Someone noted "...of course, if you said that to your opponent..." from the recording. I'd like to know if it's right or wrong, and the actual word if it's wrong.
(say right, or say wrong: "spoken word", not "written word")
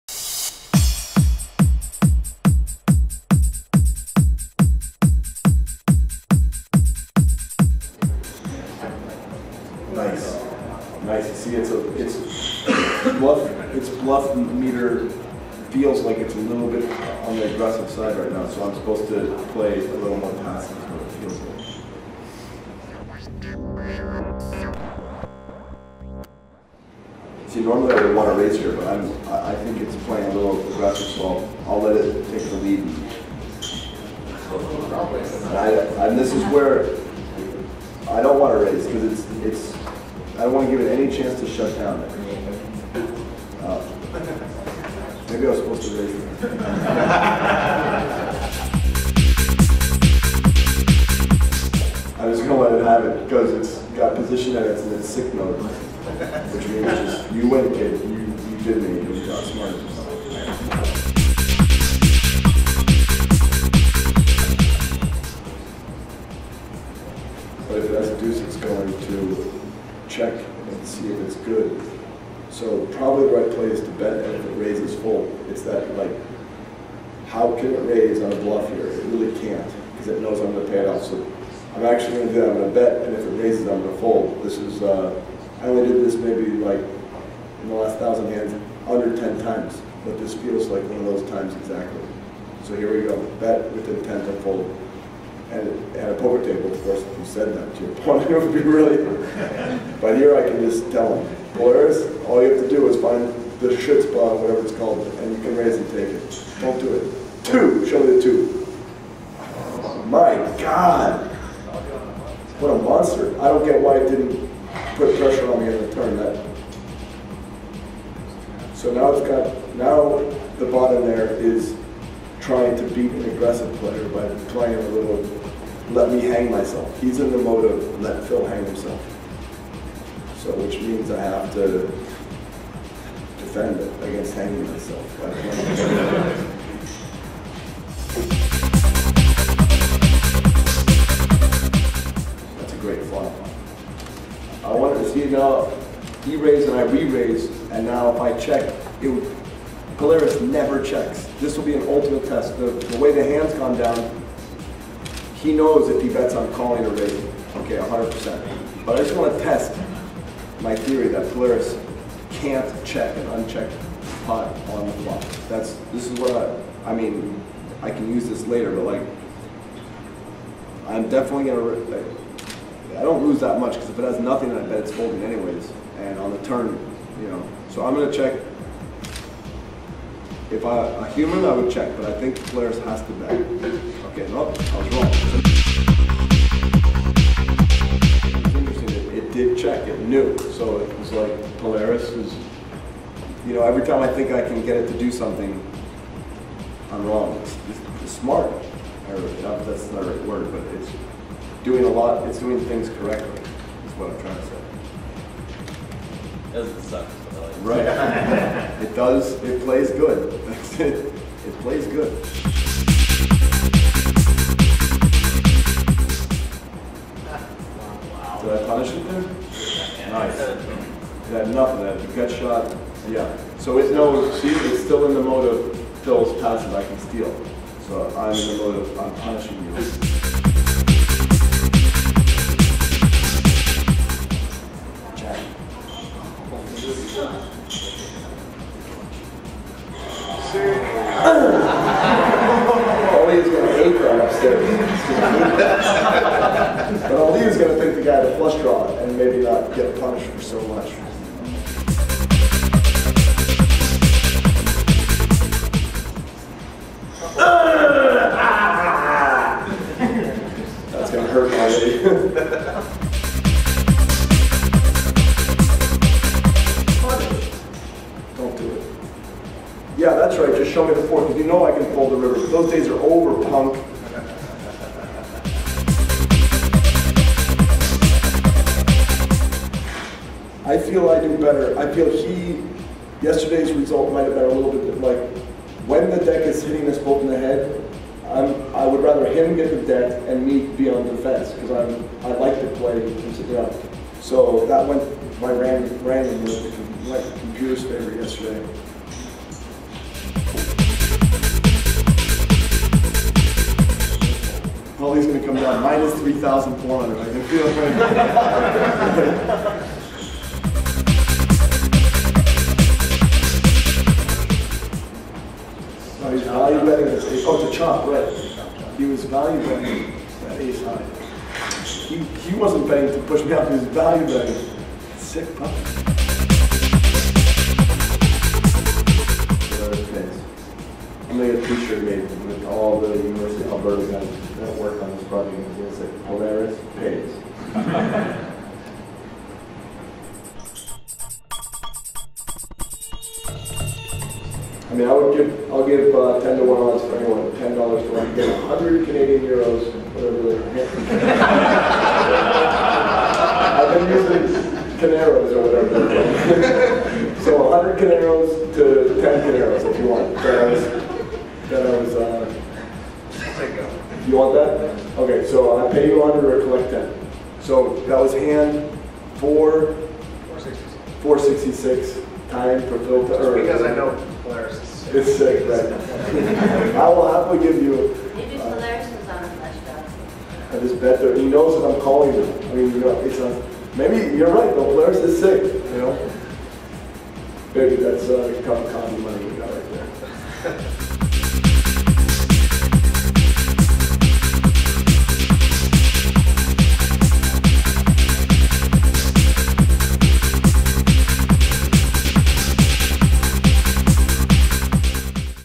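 right.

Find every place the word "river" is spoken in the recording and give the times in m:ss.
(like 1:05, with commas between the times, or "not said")
4:32.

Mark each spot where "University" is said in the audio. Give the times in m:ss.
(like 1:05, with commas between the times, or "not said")
5:33.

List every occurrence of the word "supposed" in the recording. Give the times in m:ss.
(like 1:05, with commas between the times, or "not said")
0:18, 0:45.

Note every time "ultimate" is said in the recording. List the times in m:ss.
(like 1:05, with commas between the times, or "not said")
2:31.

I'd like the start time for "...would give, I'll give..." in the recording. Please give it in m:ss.
5:45.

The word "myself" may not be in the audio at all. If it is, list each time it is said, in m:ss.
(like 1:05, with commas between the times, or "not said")
2:06, 2:14.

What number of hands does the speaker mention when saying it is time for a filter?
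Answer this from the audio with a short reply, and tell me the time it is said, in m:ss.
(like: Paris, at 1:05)
466, at 6:11.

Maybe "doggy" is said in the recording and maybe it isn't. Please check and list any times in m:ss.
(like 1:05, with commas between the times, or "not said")
not said.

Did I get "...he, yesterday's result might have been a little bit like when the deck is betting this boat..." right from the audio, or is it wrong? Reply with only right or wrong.
wrong.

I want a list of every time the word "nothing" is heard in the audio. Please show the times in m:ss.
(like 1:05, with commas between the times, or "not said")
2:54.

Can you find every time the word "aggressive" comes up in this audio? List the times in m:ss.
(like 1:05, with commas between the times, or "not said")
0:17, 0:30, 2:03.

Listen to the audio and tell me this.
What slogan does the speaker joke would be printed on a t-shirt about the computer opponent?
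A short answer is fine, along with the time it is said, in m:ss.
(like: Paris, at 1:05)
Polaris pays, at 5:36.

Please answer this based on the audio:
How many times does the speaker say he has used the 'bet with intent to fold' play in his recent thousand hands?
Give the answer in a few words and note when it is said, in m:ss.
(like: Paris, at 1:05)
under 10, at 1:28.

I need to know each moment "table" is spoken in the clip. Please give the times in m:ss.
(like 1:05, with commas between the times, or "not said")
1:36.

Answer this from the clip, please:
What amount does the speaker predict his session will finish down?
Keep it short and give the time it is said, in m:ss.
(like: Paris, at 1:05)
3,400, at 5:05.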